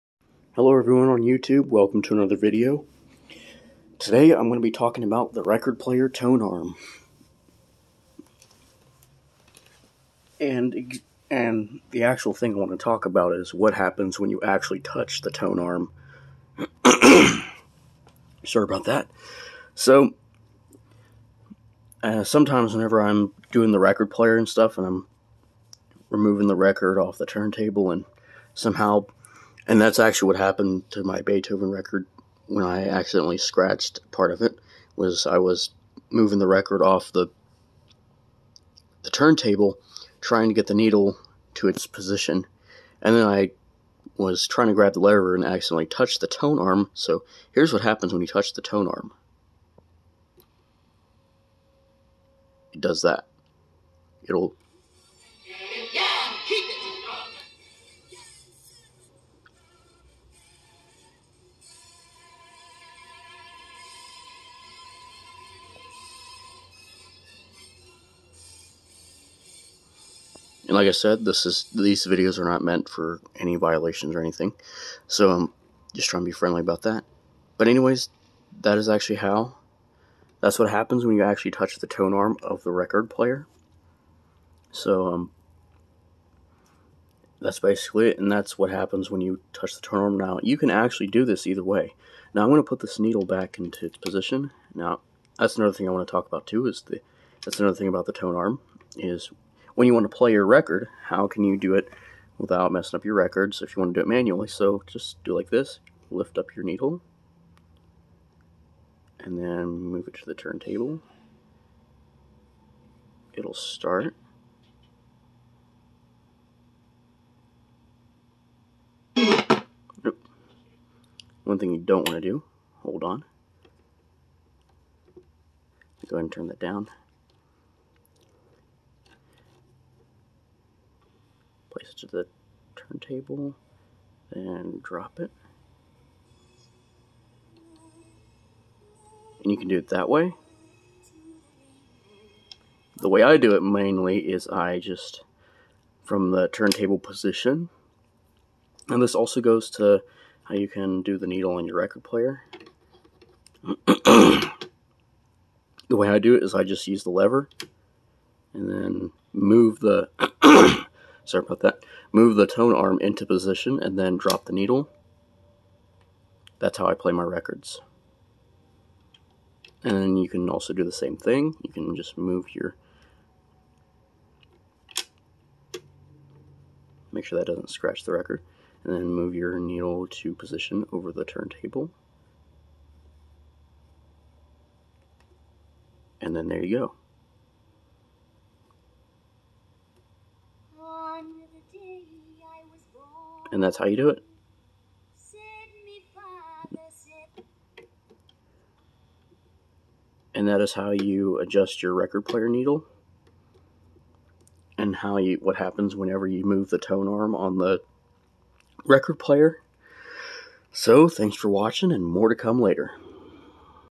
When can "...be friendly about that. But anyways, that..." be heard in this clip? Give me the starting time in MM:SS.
01:16.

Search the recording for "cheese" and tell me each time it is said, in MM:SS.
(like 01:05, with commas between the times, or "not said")
not said.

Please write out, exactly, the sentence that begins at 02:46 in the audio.
That's how I play my records.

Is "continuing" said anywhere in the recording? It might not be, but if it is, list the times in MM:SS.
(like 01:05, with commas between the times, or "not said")
not said.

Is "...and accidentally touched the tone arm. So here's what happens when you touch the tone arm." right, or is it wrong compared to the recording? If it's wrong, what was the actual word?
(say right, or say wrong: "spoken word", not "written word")
right.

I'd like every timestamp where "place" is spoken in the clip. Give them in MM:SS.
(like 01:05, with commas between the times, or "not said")
02:11.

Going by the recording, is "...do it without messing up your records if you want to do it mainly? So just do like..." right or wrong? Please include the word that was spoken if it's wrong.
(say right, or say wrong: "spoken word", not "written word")
wrong: "manually", not "mainly".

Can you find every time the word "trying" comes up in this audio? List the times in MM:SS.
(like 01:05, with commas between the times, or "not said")
00:40, 00:44, 01:16.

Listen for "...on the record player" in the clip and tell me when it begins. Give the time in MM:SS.
03:27.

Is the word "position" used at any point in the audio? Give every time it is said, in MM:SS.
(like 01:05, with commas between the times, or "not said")
00:41, 01:33, 02:26, 02:43, 03:00.